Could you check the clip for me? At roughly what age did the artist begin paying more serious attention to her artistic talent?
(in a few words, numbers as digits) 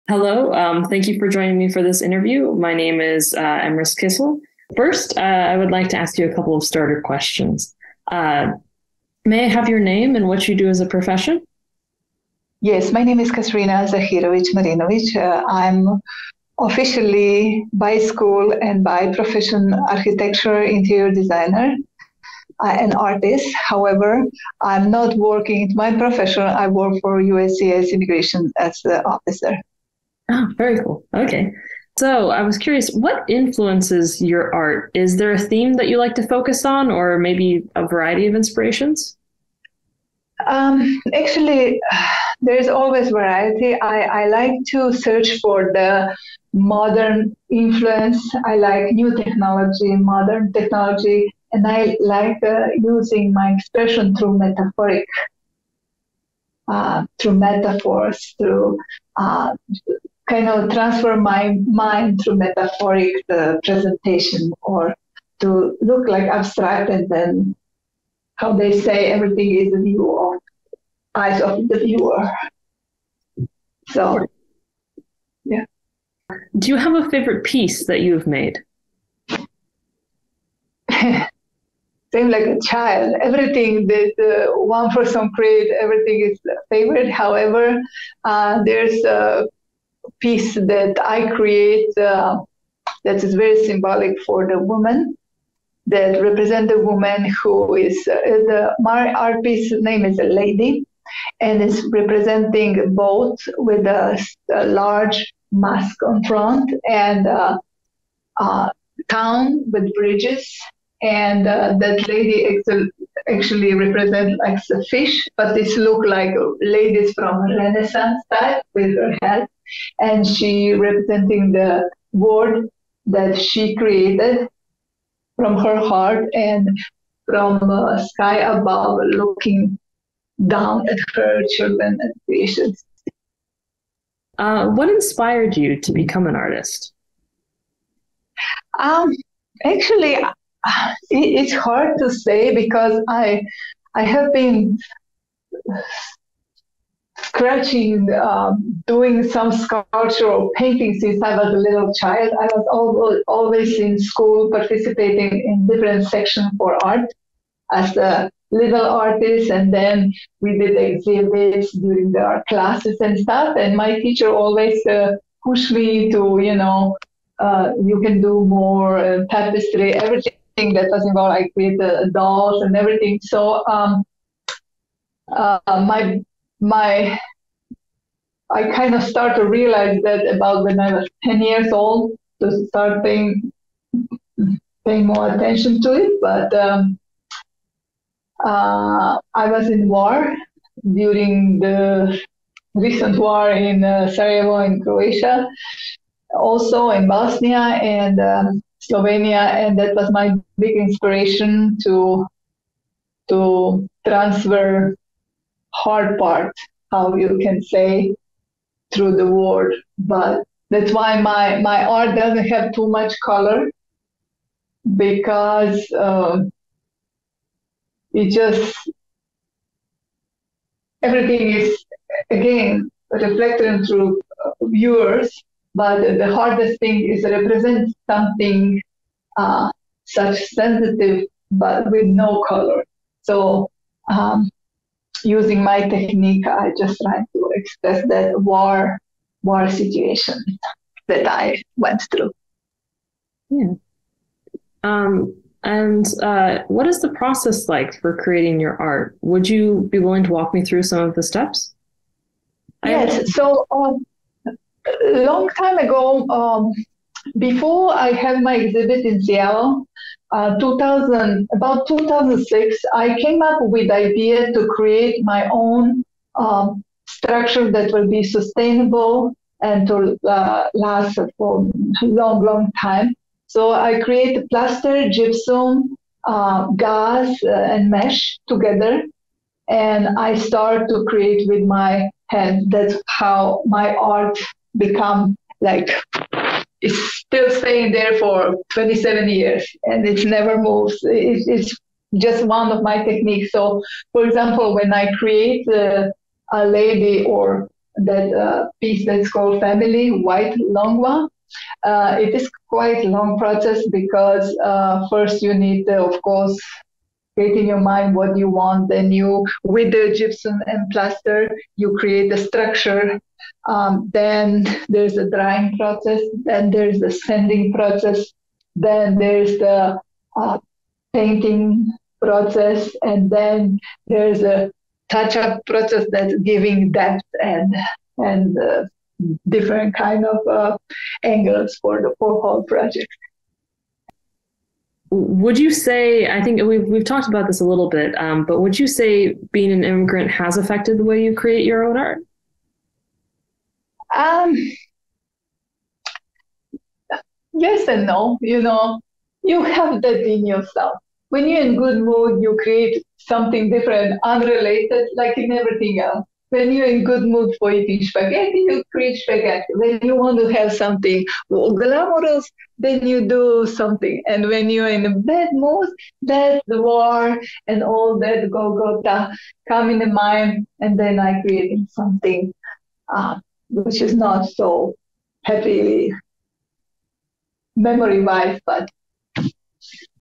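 10.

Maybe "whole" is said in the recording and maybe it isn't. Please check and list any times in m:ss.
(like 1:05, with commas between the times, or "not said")
5:32.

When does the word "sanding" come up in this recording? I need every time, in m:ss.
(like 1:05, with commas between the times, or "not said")
5:17.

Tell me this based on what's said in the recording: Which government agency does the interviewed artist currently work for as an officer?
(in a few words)
USCIS.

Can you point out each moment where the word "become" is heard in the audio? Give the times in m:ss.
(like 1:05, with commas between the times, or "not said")
2:15, 4:44.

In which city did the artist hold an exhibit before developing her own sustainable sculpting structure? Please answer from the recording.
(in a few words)
Seattle.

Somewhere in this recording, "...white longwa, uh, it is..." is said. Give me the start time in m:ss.
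5:00.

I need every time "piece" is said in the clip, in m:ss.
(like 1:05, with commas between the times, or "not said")
1:17, 1:30, 1:39, 4:58.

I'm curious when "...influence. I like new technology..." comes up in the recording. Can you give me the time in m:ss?
0:47.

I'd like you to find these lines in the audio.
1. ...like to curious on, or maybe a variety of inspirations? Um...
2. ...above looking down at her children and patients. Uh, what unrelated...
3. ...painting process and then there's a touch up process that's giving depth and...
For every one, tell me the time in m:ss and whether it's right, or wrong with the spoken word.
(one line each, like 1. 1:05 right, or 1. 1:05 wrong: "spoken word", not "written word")
1. 0:35 wrong: "focus", not "curious"
2. 2:08 wrong: "inspired", not "unrelated"
3. 5:21 right.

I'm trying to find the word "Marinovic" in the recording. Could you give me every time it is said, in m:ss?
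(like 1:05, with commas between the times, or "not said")
0:14.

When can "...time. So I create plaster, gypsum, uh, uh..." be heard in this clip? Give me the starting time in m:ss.
4:32.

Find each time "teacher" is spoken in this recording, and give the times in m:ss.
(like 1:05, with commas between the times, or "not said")
2:44.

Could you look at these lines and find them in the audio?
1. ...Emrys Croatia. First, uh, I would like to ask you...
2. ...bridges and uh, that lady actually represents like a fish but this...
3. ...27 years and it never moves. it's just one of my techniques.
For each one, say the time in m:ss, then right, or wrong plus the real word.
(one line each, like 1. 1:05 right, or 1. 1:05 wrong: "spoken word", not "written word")
1. 0:03 wrong: "Kissel", not "Croatia"
2. 1:49 right
3. 4:48 right.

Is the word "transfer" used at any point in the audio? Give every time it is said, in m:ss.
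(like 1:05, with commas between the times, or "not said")
1:00, 3:24.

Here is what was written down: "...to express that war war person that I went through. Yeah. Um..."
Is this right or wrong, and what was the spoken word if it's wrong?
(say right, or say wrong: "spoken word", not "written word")
wrong: "situation", not "person".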